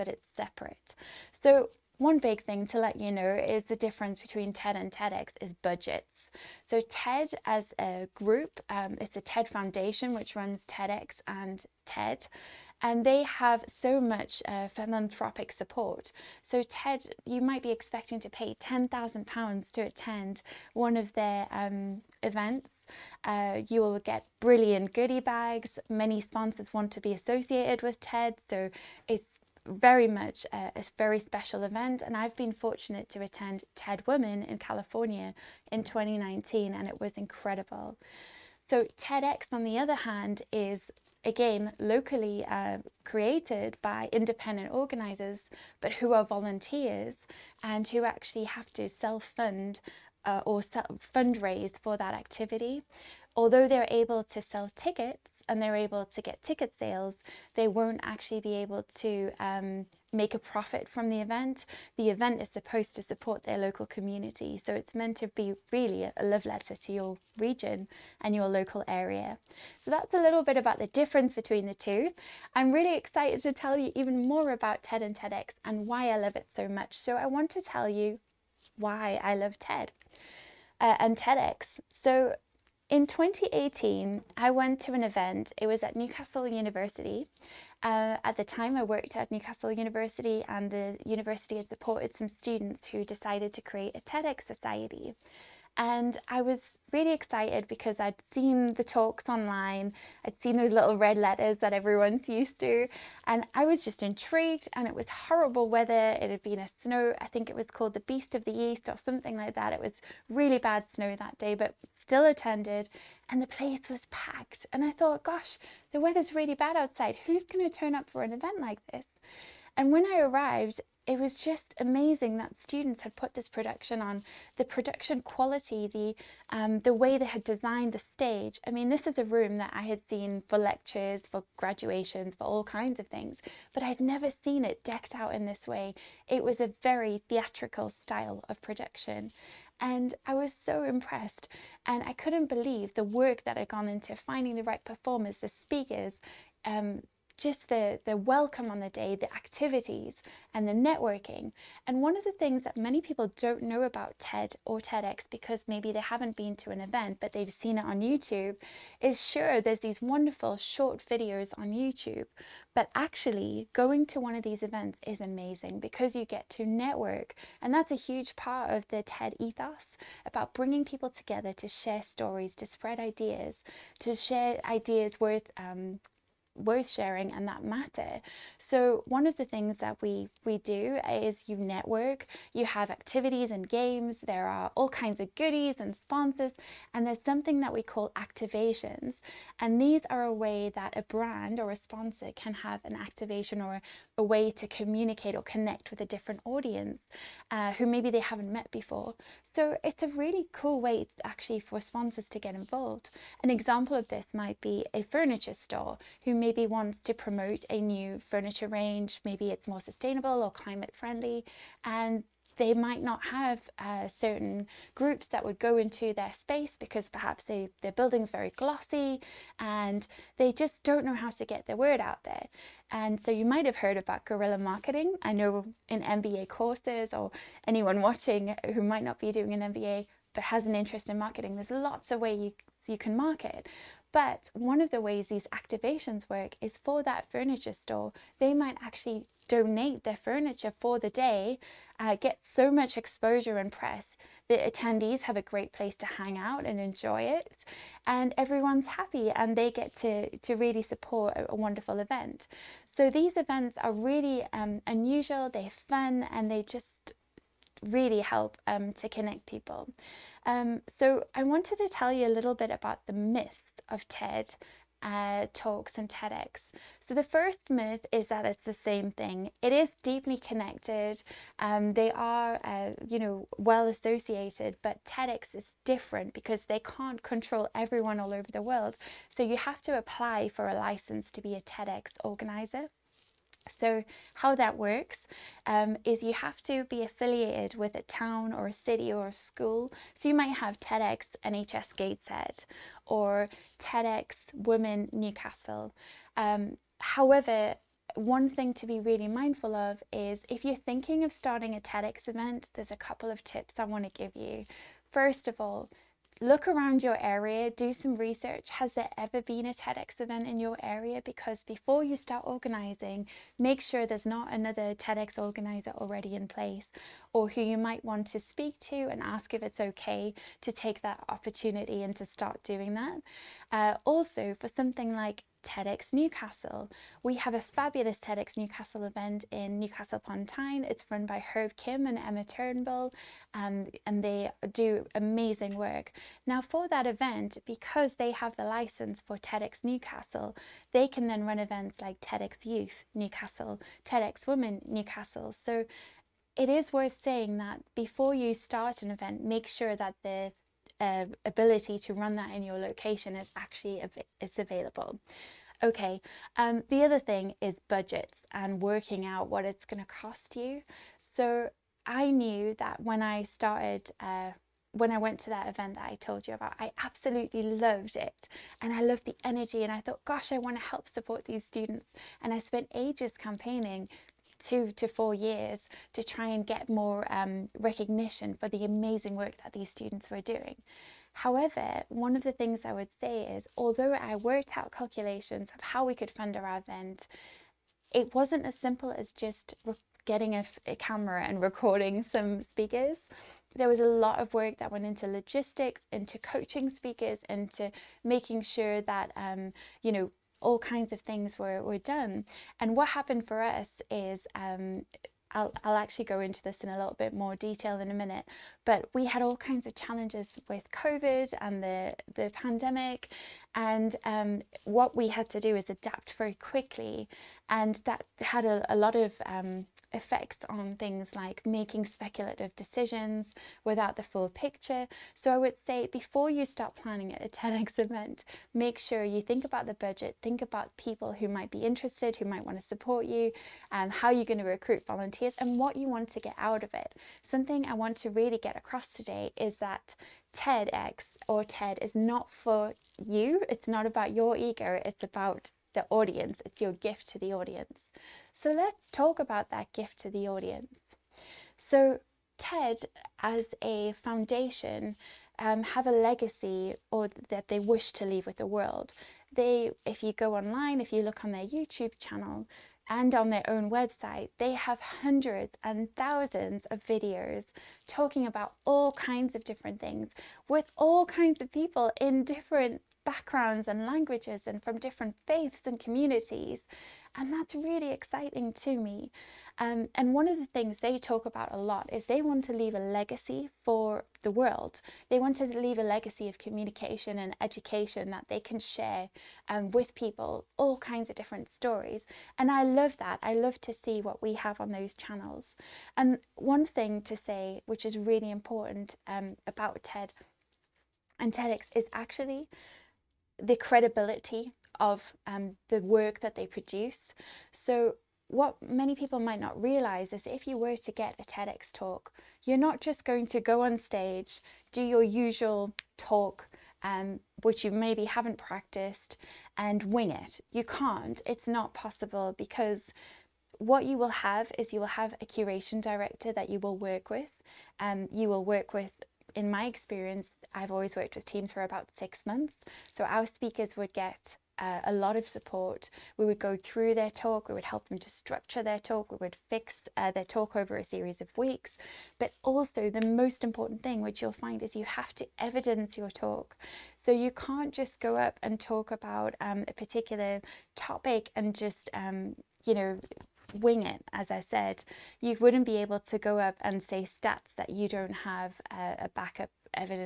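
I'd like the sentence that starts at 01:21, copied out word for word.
So in 2018, I went to an event.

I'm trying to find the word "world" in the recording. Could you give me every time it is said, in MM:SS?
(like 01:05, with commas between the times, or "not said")
04:38, 07:38, 08:04.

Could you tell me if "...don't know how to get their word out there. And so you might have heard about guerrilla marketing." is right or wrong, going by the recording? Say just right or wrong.
right.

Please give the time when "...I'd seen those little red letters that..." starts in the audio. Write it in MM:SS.
01:40.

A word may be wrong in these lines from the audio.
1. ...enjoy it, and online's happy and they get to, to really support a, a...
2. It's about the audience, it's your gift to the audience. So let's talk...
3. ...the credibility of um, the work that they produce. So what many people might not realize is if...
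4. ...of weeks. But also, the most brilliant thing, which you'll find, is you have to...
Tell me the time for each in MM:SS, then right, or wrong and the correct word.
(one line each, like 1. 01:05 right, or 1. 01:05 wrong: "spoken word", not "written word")
1. 04:06 wrong: "everyone", not "online"
2. 07:25 right
3. 08:23 right
4. 09:01 wrong: "important", not "brilliant".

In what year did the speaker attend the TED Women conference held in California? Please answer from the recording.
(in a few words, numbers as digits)
2019.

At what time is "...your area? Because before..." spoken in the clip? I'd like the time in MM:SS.
05:10.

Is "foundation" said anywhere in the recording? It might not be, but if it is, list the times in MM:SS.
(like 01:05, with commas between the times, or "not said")
00:09, 07:34.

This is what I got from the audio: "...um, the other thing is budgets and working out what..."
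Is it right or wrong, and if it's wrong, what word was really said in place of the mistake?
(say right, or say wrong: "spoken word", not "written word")
right.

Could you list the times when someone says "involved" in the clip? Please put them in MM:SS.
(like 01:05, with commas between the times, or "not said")
03:22.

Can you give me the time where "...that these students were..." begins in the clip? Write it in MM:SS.
06:19.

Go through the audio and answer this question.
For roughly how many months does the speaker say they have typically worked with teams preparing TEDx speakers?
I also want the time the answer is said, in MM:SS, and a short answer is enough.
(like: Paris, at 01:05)
6 months, at 08:52.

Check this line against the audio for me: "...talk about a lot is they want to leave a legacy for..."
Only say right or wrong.
right.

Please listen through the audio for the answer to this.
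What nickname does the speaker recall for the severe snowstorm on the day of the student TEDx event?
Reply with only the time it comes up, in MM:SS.
01:48.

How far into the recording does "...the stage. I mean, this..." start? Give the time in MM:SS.
02:07.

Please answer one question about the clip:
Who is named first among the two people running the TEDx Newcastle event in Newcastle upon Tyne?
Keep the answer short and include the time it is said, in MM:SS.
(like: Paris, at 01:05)
Herb Kim, at 05:31.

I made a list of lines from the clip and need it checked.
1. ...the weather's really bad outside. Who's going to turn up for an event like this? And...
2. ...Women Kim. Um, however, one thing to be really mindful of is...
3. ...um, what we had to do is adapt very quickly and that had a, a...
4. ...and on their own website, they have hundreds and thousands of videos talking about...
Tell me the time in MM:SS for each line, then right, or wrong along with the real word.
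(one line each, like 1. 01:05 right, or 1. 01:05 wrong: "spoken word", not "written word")
1. 01:55 right
2. 04:54 wrong: "Newcastle", not "Kim"
3. 06:54 right
4. 07:43 right.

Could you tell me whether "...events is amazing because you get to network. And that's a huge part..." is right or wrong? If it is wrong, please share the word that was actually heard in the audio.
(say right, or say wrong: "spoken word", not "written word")
right.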